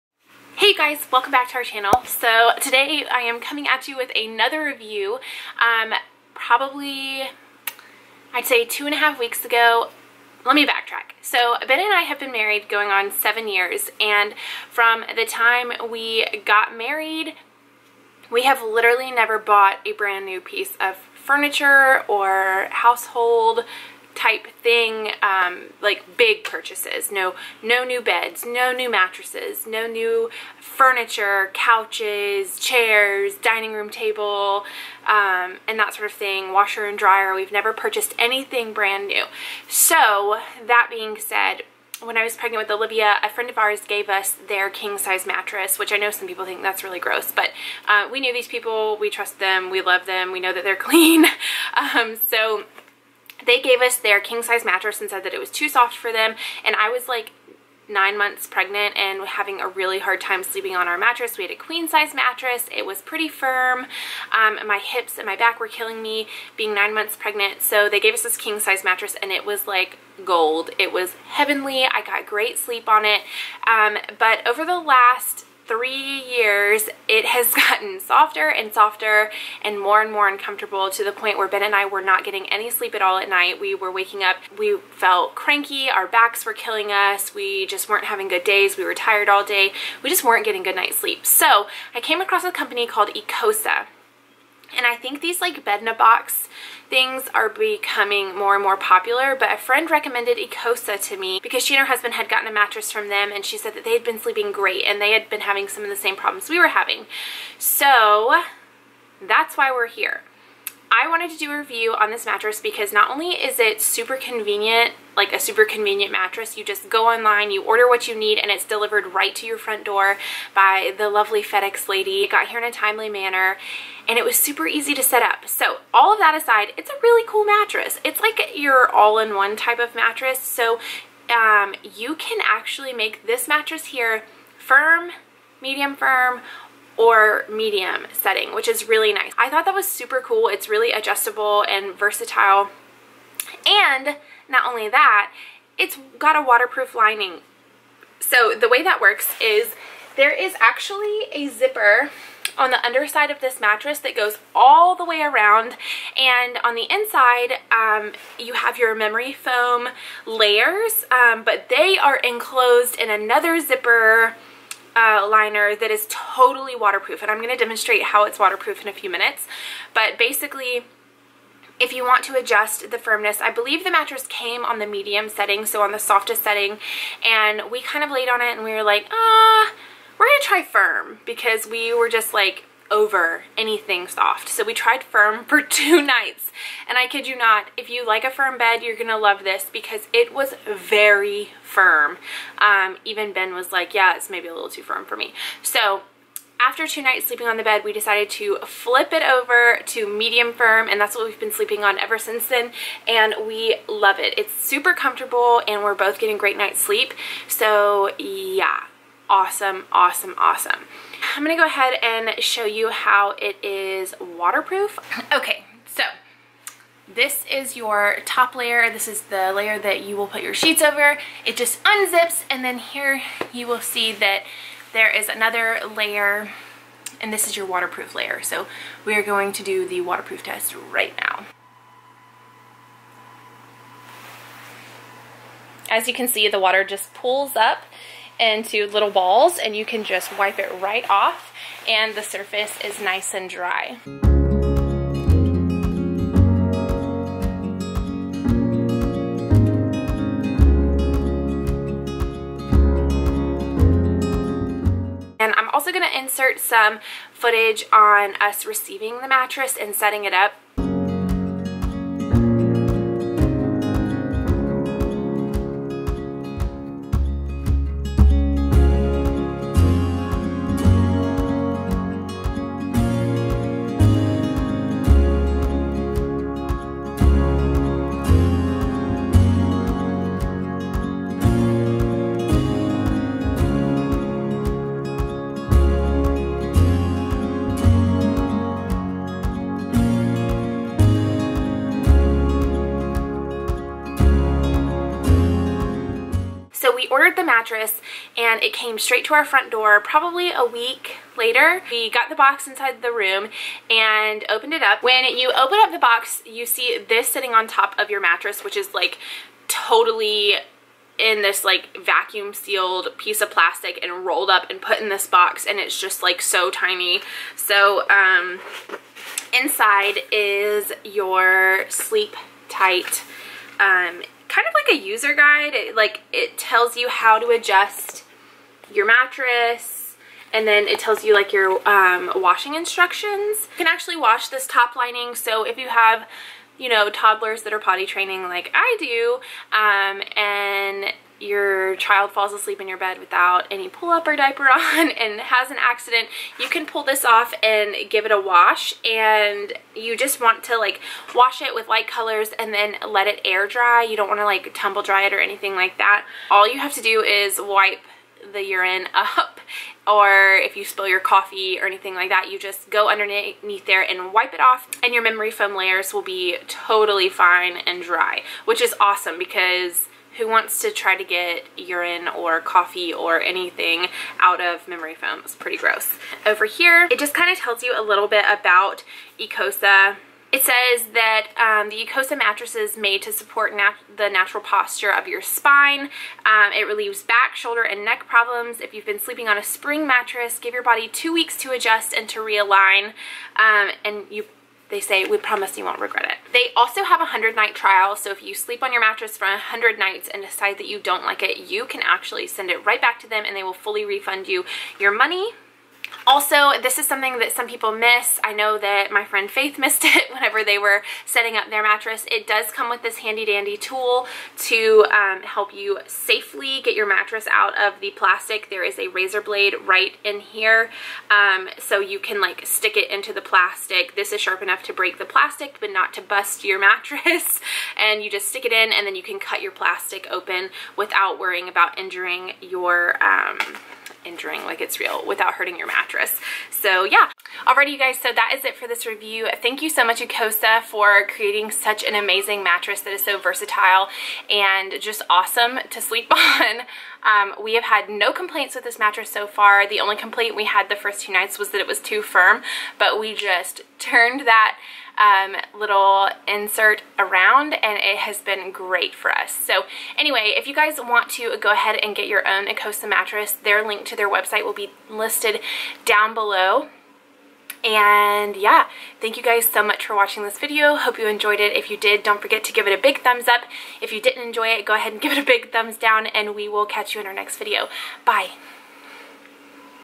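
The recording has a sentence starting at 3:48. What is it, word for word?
So we are going to do the waterproof test right now.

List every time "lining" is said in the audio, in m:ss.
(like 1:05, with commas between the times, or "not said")
2:26, 5:34.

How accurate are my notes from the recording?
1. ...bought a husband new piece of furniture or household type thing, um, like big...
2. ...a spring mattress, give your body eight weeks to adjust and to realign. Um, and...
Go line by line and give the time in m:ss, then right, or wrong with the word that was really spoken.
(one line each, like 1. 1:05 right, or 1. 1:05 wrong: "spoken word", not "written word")
1. 0:19 wrong: "brand", not "husband"
2. 6:29 wrong: "two", not "eight".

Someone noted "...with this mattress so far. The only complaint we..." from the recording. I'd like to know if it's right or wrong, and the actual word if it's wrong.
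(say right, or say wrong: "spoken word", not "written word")
right.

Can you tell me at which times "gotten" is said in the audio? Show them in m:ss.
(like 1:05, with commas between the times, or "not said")
1:17, 1:42.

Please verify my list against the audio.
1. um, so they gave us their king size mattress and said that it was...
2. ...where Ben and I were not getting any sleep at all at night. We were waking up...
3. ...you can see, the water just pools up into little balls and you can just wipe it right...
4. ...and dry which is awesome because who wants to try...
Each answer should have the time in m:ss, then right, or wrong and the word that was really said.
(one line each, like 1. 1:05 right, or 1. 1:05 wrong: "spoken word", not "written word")
1. 0:51 right
2. 1:21 right
3. 3:56 right
4. 6:07 right.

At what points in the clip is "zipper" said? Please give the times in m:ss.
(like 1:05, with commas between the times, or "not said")
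2:31, 2:43.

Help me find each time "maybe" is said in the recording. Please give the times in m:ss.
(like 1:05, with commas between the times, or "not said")
3:14.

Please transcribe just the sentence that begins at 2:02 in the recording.
It got here in a timely manner, and it was super easy to set up.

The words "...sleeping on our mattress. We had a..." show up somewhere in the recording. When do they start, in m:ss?
1:00.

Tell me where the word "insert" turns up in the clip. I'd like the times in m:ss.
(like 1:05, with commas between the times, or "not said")
4:16, 7:36.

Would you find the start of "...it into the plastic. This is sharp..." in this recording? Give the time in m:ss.
7:02.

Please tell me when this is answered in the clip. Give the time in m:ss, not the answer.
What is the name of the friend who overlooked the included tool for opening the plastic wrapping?
6:49.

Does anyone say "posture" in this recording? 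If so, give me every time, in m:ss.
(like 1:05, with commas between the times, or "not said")
6:24.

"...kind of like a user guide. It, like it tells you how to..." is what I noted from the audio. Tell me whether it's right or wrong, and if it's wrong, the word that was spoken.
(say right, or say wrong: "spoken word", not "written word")
right.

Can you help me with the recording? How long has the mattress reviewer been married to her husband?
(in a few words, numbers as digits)
7 years.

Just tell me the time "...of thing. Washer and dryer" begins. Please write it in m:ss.
0:36.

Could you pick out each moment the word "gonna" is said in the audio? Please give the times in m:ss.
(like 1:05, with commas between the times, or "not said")
3:00, 3:08, 3:31.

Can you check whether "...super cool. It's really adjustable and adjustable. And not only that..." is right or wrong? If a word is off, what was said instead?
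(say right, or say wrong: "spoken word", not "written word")
wrong: "versatile", not "adjustable".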